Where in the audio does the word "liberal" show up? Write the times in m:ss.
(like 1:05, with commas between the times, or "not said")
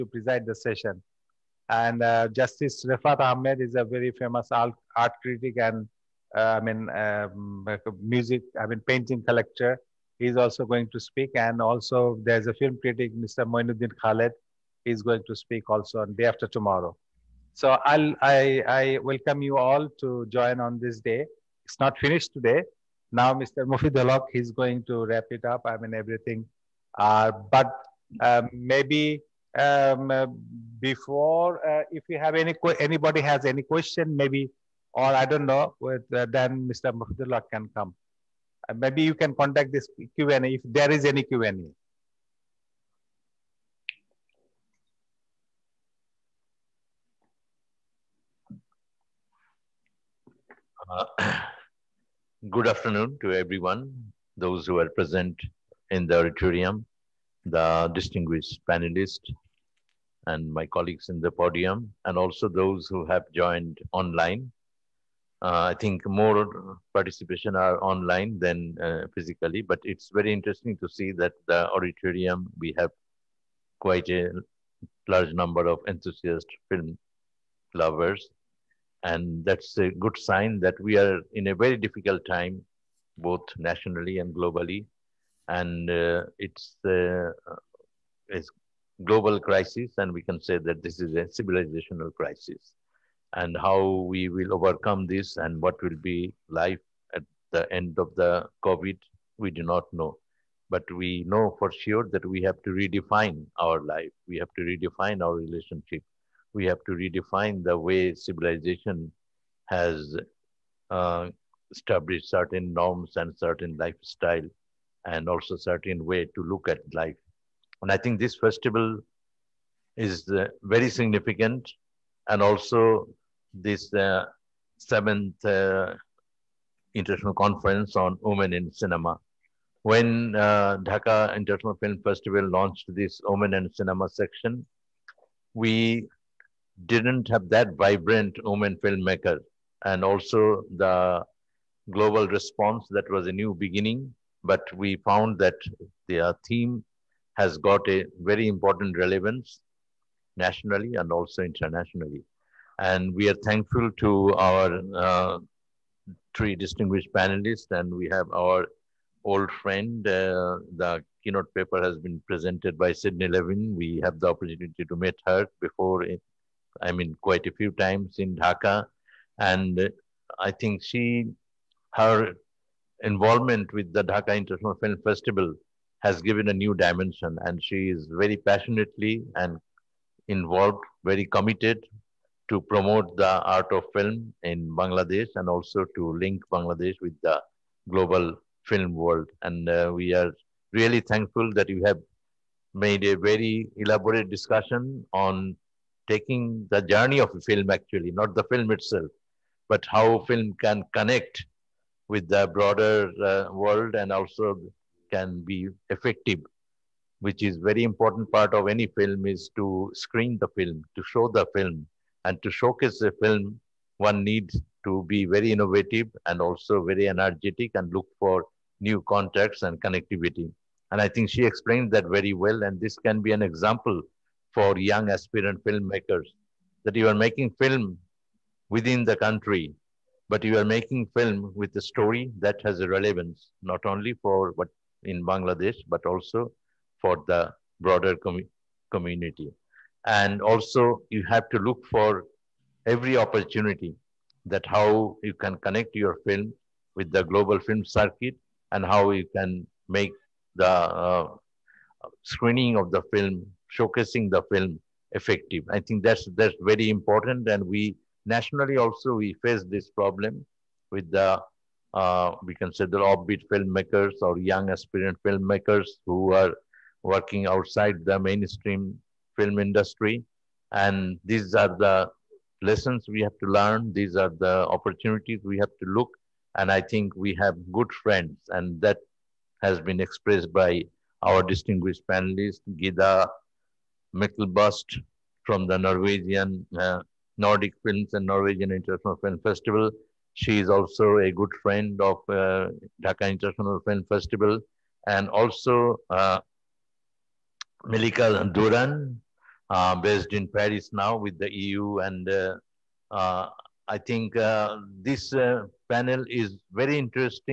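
not said.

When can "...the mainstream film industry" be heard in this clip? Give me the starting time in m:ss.
4:28.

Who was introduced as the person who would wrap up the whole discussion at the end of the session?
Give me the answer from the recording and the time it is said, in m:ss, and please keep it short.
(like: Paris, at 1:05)
Mofidul Haque, at 0:23.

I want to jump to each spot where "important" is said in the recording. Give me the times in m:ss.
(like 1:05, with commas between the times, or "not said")
2:28, 3:27, 4:16.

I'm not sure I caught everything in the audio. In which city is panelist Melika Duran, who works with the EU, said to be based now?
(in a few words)
Paris.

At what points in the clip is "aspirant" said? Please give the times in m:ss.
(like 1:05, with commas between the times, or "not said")
3:45, 4:24.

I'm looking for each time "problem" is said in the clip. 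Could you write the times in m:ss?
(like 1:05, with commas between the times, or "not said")
4:19.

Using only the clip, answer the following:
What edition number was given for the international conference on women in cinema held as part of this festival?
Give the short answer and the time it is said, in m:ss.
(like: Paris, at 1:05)
seventh, at 2:04.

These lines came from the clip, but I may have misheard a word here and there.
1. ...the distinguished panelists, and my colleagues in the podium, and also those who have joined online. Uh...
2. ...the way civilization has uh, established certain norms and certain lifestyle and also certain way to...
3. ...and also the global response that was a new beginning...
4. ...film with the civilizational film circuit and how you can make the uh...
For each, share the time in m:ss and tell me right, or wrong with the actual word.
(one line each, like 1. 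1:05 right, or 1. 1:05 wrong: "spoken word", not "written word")
1. 0:57 right
2. 1:47 right
3. 2:19 right
4. 4:06 wrong: "global", not "civilizational".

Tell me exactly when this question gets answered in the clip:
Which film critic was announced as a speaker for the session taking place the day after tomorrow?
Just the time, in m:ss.
0:13.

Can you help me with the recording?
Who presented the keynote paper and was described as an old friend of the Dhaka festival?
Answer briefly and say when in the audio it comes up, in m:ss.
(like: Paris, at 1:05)
Sydney Levine, at 2:42.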